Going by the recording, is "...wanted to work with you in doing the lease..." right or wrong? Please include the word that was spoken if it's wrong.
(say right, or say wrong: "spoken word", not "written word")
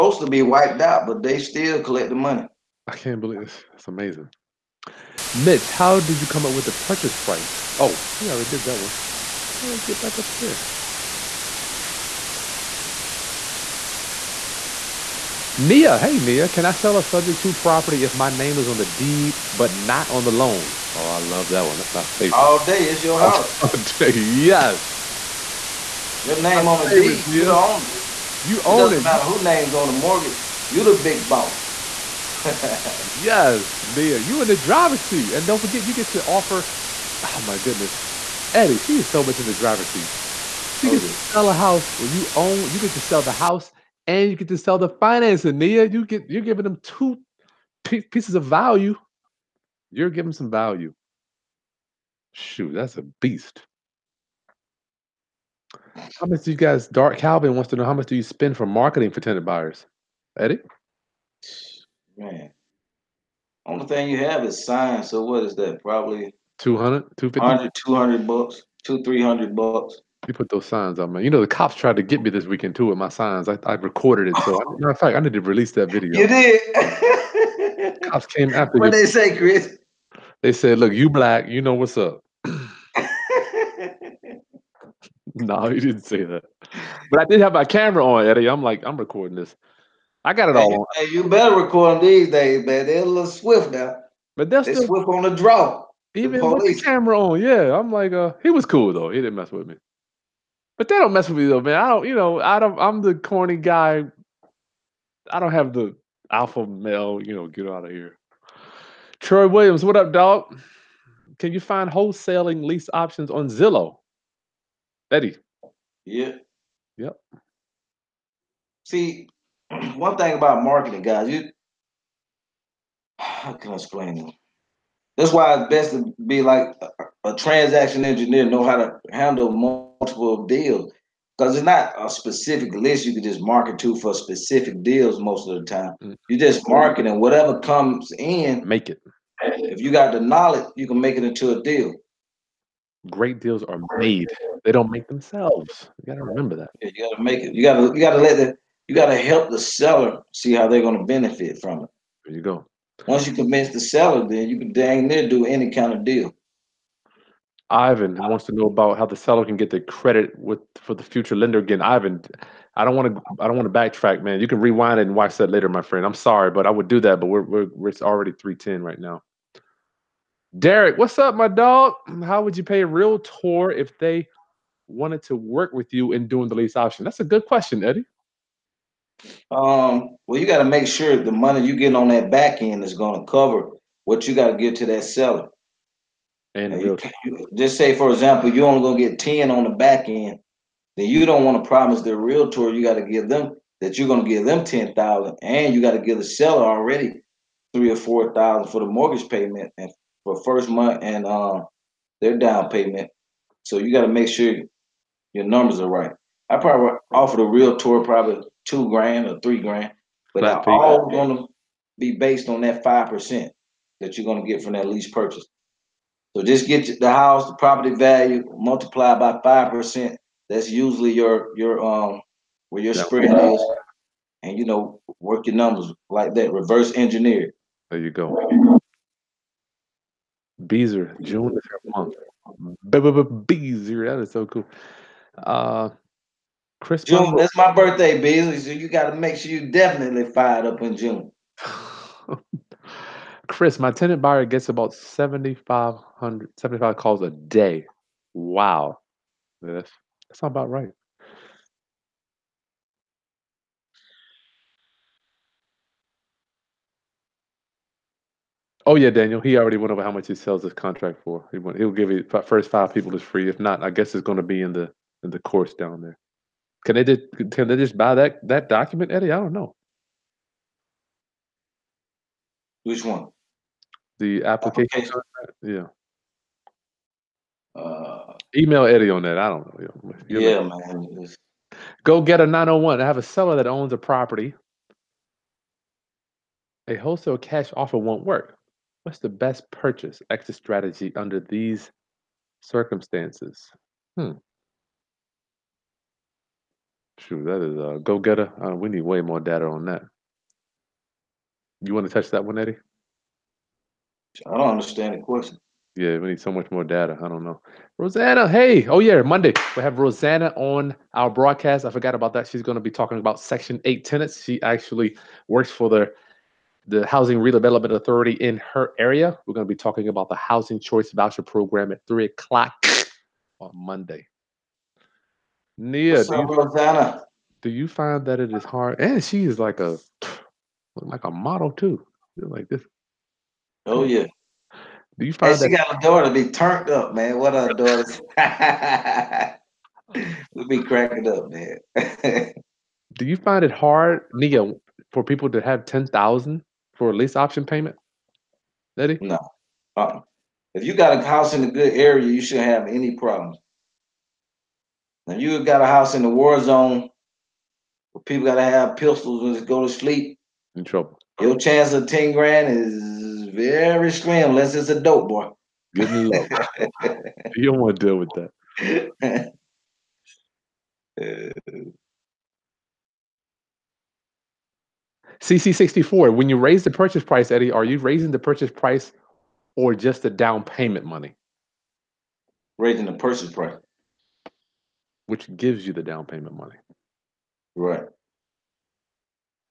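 right.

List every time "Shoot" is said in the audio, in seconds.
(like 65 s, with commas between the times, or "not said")
52 s, 297 s.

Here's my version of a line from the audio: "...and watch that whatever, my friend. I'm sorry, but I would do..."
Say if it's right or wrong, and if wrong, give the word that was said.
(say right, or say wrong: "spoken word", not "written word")
wrong: "later", not "whatever".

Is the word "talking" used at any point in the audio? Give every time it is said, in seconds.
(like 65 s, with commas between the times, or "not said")
312 s, 319 s.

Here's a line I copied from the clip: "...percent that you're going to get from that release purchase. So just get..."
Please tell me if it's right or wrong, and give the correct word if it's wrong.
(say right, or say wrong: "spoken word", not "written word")
wrong: "lease", not "release".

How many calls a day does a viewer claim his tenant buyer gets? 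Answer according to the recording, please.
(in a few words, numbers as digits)
7,500.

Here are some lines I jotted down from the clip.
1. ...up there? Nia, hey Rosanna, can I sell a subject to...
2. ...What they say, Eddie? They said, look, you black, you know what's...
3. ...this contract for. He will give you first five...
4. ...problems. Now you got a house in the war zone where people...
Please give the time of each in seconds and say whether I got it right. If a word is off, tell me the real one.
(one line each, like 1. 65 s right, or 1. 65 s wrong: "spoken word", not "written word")
1. 10 s wrong: "Nia", not "Rosanna"
2. 78 s wrong: "Kris", not "Eddie"
3. 260 s right
4. 353 s right.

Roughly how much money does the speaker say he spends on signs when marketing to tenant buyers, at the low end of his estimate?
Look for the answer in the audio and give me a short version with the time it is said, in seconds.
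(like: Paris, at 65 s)
$200, at 65 s.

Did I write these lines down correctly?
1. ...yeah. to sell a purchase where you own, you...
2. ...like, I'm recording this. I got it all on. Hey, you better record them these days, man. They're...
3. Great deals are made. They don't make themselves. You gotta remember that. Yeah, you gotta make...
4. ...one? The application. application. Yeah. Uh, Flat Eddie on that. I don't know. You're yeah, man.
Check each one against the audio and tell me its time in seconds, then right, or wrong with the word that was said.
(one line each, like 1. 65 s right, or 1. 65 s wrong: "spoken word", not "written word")
1. 41 s wrong: "house", not "purchase"
2. 88 s right
3. 143 s right
4. 273 s wrong: "Email", not "Flat".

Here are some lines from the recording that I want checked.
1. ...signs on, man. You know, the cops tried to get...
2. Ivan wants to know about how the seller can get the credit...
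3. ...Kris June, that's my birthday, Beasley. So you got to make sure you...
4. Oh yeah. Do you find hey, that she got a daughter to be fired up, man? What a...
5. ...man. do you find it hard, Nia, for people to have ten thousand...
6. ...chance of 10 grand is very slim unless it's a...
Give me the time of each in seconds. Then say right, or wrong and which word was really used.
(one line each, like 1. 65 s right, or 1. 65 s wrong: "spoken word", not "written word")
1. 70 s right
2. 157 s right
3. 236 s right
4. 333 s wrong: "turned", not "fired"
5. 341 s right
6. 361 s right.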